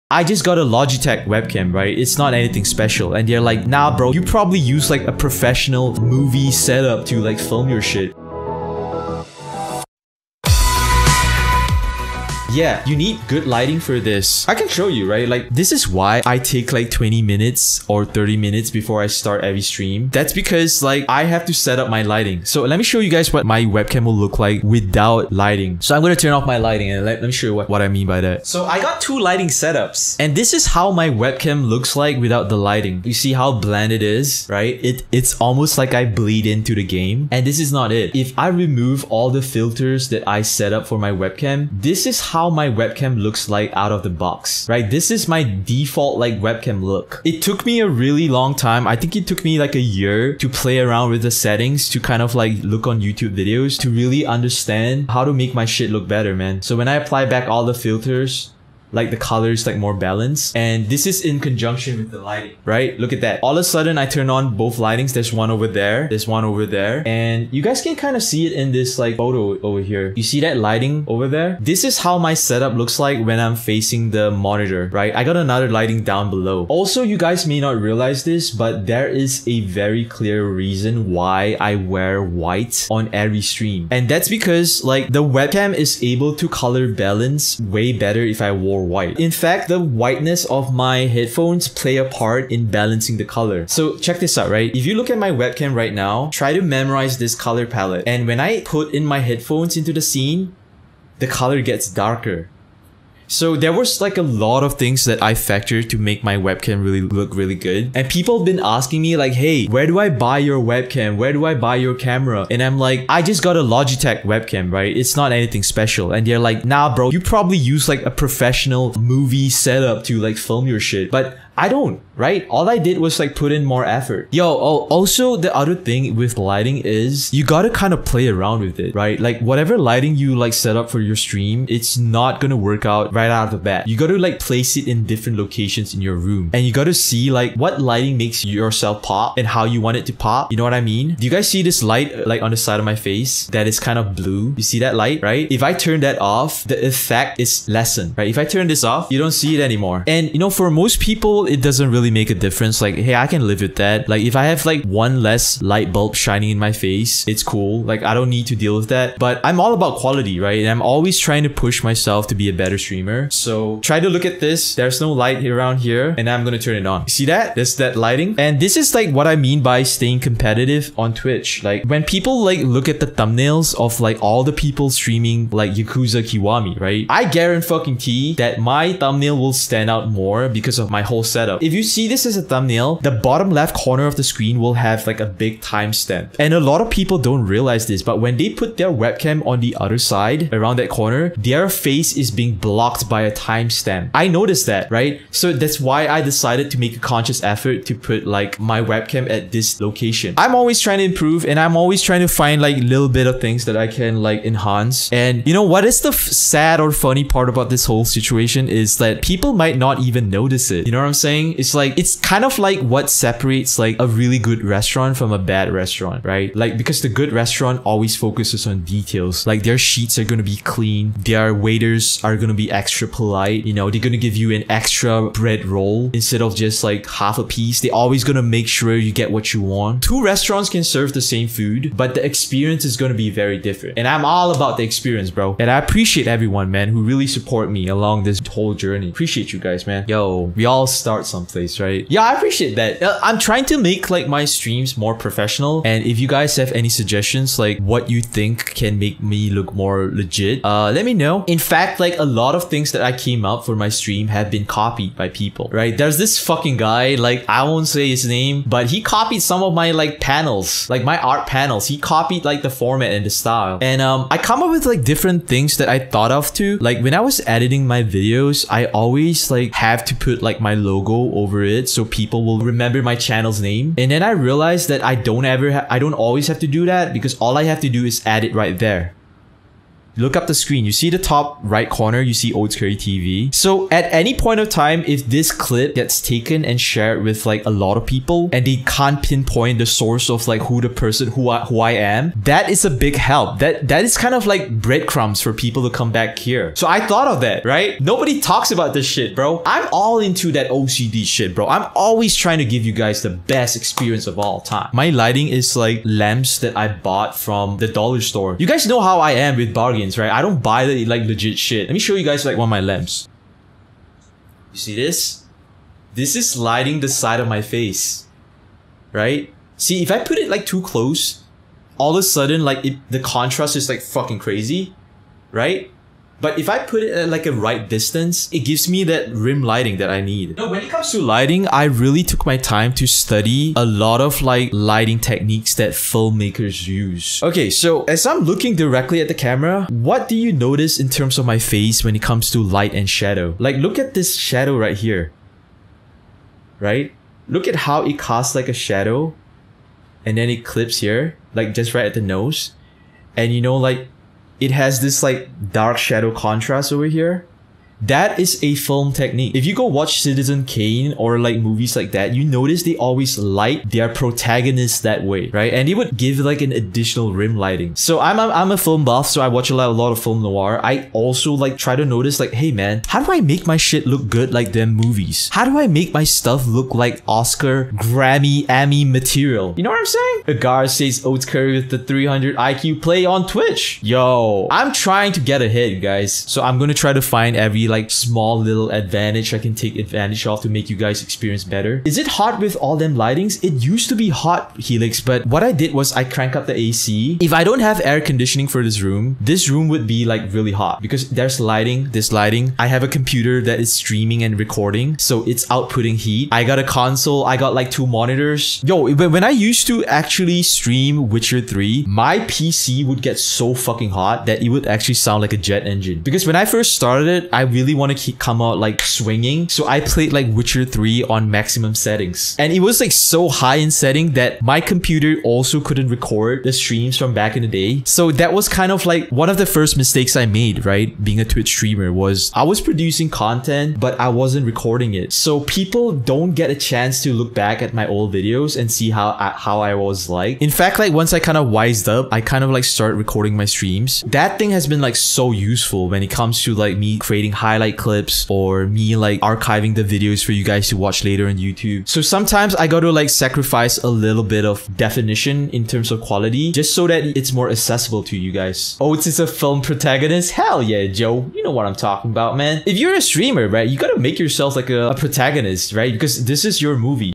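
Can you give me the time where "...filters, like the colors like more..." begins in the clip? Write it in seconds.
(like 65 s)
57 s.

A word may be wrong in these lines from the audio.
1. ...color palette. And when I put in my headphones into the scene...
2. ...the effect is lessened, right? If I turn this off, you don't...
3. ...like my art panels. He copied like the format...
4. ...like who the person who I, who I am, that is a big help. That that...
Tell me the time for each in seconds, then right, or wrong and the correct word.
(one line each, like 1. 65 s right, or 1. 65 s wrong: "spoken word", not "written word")
1. 97 s right
2. 146 s right
3. 260 s right
4. 290 s right.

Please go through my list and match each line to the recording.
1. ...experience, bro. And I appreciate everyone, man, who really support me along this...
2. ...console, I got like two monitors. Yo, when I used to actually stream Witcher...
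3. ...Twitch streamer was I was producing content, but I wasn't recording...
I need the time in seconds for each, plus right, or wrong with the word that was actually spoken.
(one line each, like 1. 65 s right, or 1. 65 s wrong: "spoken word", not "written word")
1. 234 s right
2. 406 s right
3. 431 s right.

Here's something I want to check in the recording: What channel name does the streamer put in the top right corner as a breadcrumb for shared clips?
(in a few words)
Oats Curry TV.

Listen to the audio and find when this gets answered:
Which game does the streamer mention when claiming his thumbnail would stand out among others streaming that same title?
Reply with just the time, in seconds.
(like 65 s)
175 s.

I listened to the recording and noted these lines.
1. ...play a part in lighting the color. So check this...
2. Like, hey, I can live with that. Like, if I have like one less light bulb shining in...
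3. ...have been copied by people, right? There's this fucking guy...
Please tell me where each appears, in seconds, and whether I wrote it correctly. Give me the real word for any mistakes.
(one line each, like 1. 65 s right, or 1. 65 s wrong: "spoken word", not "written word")
1. 91 s wrong: "balancing", not "lighting"
2. 152 s right
3. 254 s right.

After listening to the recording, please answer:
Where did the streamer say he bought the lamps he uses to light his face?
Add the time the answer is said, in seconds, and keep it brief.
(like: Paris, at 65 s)
the dollar store, at 307 s.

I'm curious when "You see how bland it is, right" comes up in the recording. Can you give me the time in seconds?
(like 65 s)
33 s.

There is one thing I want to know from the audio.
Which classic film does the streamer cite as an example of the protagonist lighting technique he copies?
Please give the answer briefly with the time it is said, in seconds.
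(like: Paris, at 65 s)
Citizen Kane, at 360 s.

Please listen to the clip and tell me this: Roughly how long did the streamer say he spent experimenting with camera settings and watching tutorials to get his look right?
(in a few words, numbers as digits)
a year.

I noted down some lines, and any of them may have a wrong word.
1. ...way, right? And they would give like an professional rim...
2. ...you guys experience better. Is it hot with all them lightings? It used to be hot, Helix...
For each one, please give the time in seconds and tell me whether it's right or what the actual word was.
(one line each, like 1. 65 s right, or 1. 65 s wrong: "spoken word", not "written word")
1. 365 s wrong: "additional", not "professional"
2. 390 s right.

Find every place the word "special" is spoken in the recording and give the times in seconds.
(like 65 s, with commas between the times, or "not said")
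2 s, 115 s.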